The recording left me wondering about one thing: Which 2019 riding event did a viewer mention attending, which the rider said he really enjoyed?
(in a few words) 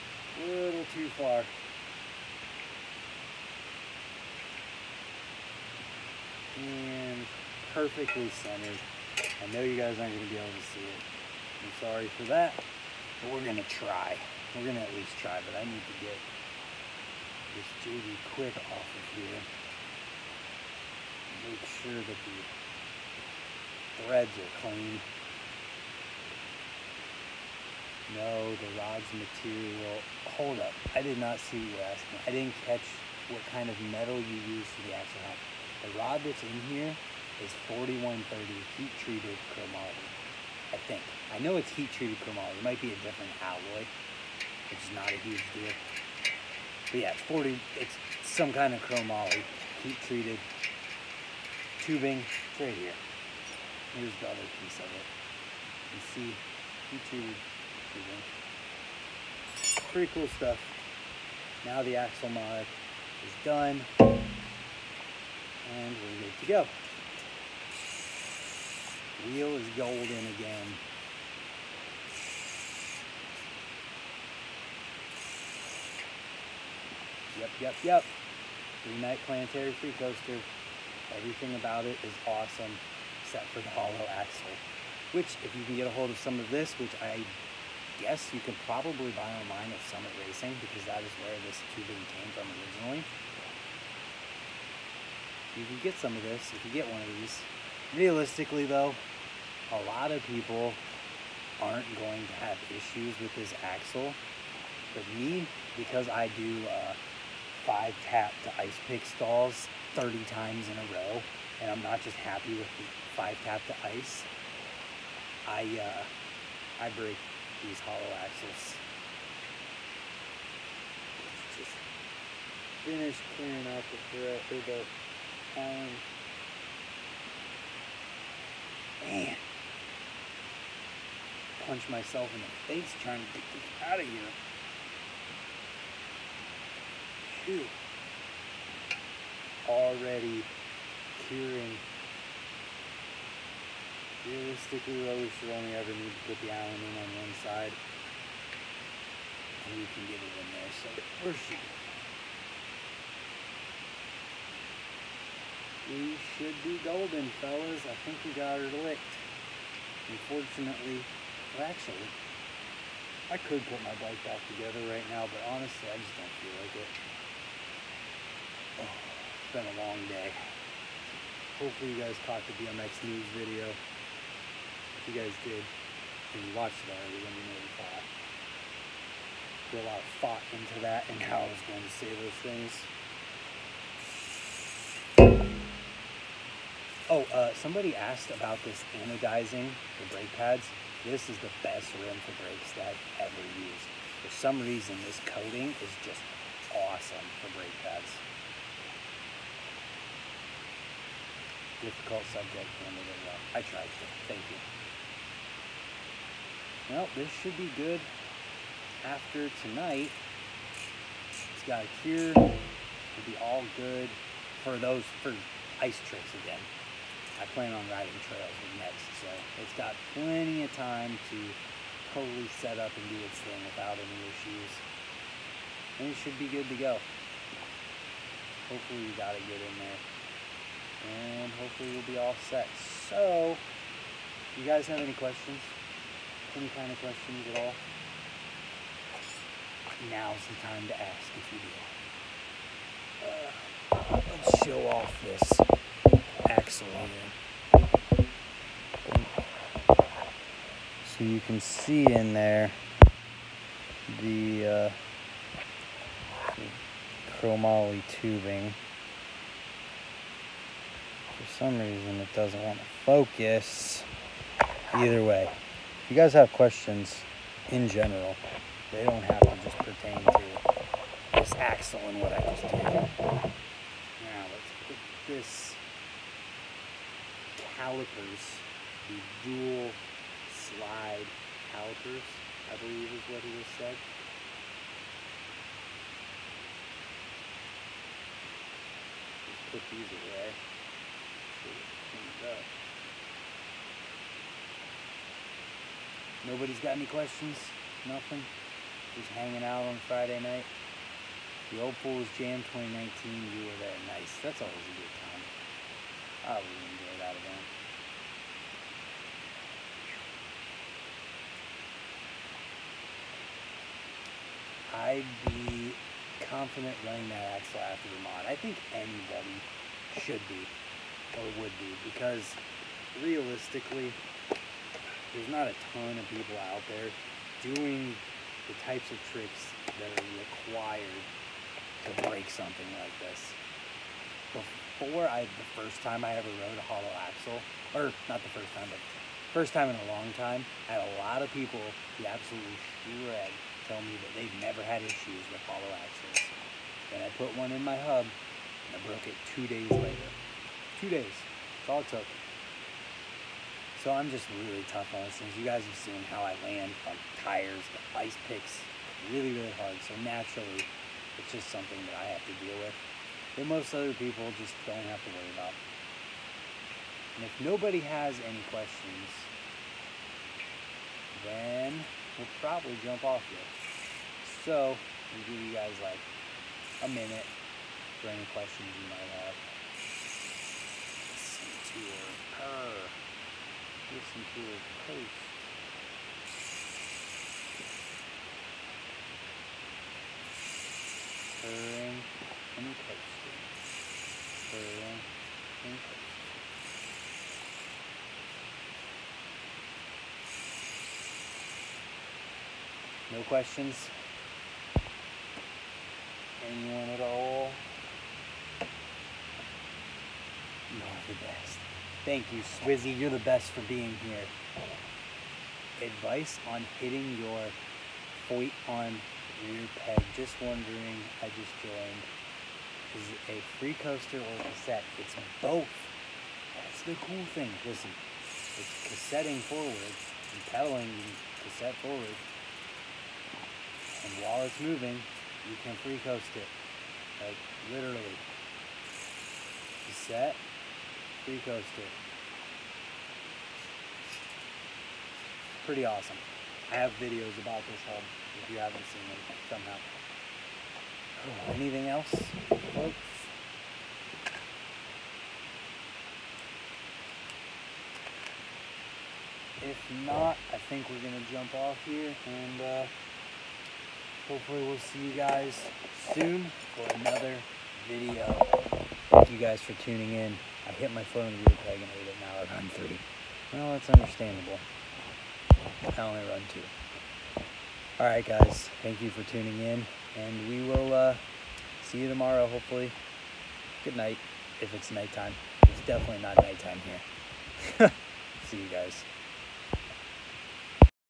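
Old Fools Jam.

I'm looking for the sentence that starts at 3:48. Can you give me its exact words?
Hopefully we got it get in there.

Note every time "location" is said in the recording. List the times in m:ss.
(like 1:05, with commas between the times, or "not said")
not said.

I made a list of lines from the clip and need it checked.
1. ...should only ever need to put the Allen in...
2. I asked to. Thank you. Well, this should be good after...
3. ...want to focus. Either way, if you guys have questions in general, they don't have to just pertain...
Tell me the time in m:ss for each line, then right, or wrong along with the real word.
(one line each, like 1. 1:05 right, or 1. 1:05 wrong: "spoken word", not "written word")
1. 2:25 right
2. 3:23 wrong: "tried", not "asked"
3. 4:22 right.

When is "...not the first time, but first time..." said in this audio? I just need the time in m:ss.
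5:38.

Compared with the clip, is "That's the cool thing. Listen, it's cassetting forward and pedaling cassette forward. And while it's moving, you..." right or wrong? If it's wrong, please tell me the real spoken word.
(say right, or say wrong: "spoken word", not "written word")
right.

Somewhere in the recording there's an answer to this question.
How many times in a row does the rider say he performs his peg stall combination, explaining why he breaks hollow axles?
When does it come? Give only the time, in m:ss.
1:49.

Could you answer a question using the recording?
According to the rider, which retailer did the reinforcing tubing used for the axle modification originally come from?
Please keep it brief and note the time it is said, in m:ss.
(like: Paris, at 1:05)
Summit Racing, at 1:29.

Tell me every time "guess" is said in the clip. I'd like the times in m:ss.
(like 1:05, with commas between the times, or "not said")
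1:28.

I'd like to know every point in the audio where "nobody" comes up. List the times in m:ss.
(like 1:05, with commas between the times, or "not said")
4:56, 6:07.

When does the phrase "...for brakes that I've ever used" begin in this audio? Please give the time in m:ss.
3:12.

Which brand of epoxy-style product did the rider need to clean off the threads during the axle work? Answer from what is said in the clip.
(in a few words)
JB Quick.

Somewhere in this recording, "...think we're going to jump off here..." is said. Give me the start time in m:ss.
7:40.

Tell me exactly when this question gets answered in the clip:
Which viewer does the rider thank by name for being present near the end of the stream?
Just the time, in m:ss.
6:52.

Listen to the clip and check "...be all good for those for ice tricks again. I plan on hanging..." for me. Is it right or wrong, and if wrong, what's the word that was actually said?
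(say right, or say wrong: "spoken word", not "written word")
wrong: "riding", not "hanging".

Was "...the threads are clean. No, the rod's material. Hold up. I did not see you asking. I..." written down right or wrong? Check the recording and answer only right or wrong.
right.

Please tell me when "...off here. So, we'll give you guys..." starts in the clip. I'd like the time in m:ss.
6:13.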